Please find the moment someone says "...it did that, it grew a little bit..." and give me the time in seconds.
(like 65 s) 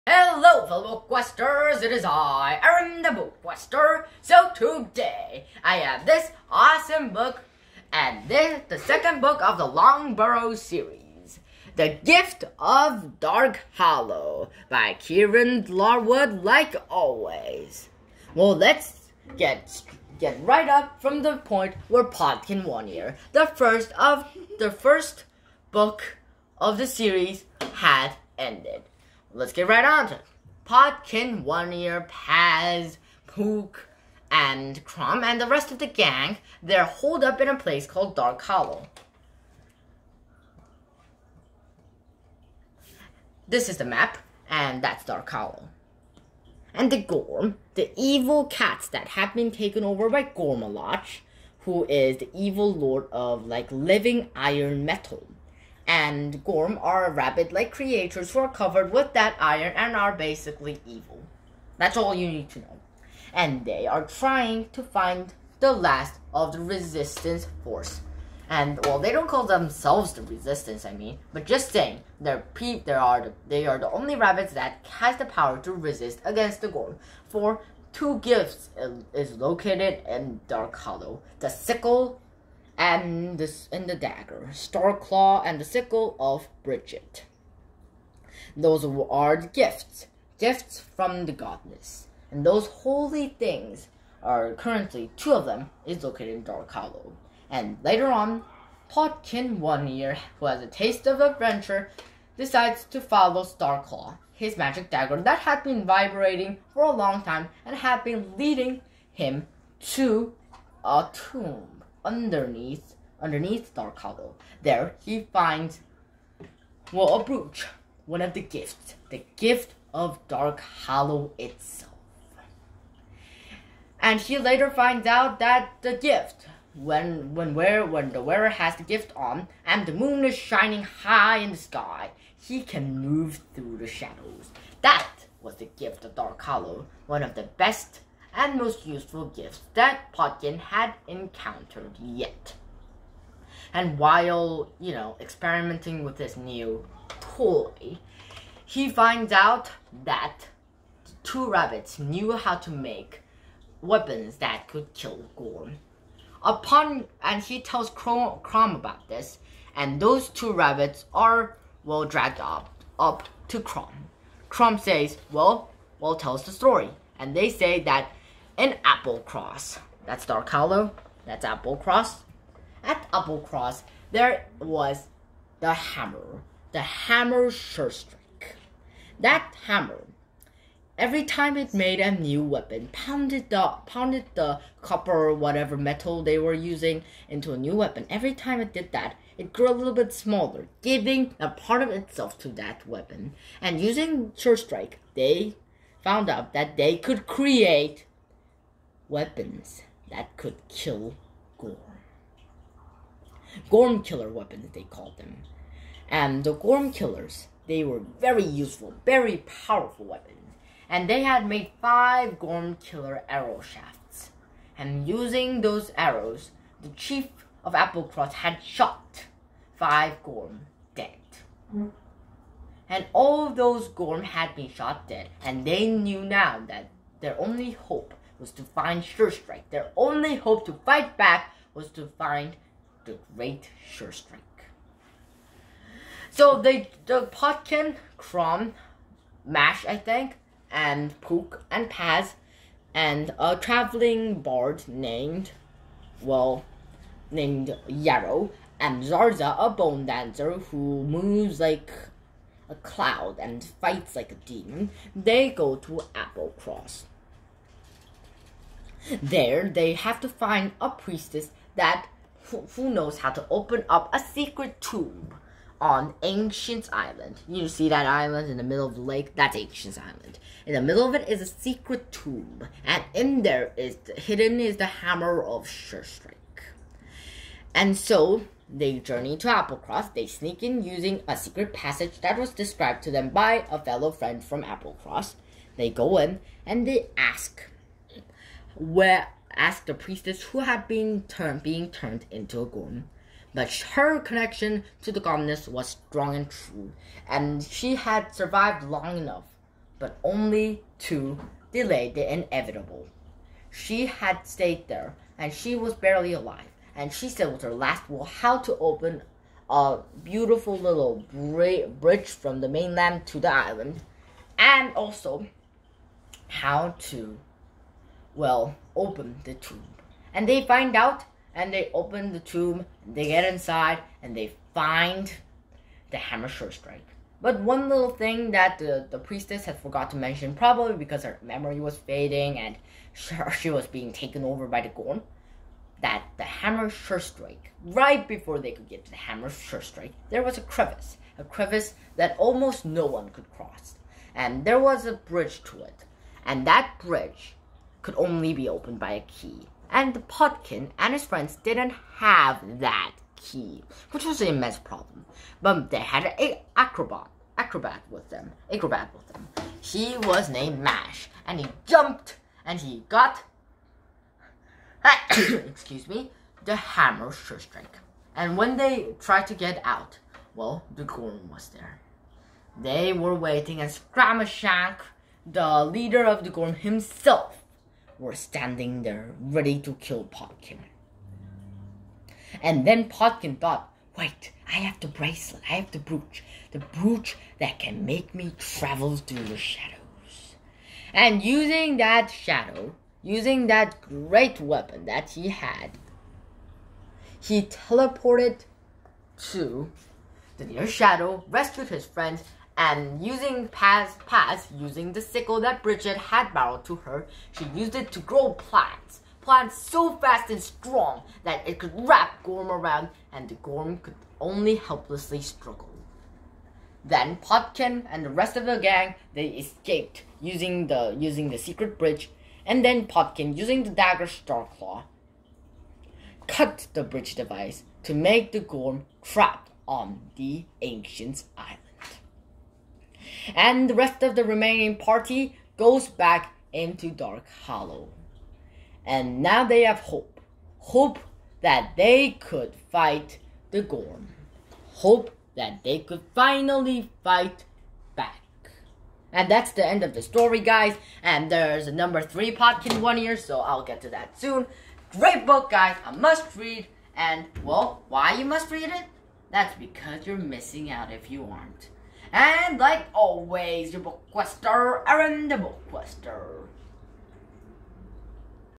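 188 s.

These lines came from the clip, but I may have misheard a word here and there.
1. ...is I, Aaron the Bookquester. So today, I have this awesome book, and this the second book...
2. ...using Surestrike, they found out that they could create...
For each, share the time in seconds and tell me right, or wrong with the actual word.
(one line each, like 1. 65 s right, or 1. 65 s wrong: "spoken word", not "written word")
1. 1 s right
2. 193 s right.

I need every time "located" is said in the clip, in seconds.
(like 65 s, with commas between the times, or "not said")
79 s, 96 s.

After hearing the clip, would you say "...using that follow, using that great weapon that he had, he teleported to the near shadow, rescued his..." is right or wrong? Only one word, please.
wrong.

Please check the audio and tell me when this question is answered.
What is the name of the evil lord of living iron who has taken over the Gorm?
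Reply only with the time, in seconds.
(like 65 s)
50 s.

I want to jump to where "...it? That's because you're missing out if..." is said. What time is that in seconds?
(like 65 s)
458 s.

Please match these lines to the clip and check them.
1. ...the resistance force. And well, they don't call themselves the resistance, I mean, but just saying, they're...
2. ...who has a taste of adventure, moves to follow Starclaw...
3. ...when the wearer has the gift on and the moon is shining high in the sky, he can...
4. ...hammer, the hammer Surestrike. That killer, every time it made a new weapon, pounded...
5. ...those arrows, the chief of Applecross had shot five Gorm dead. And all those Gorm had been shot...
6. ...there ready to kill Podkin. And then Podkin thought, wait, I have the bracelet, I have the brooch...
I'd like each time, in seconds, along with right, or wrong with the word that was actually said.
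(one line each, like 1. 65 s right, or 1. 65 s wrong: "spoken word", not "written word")
1. 66 s right
2. 100 s wrong: "decides", not "moves"
3. 127 s right
4. 175 s wrong: "hammer", not "killer"
5. 215 s right
6. 379 s right.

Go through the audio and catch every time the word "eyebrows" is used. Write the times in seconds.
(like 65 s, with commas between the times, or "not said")
not said.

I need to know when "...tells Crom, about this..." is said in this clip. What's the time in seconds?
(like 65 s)
157 s.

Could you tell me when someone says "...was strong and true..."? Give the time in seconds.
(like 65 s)
295 s.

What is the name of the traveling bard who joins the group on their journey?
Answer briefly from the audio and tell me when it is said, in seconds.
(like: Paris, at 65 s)
Yarrow, at 247 s.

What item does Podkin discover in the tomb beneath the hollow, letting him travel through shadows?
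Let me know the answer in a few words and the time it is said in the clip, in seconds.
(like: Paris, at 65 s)
A brooch, at 117 s.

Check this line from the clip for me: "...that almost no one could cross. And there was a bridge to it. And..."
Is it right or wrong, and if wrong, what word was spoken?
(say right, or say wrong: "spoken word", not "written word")
right.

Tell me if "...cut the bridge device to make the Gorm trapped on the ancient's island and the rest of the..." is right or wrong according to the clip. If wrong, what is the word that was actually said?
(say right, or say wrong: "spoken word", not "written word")
right.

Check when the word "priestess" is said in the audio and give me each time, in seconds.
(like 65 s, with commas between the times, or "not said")
260 s, 289 s, 329 s.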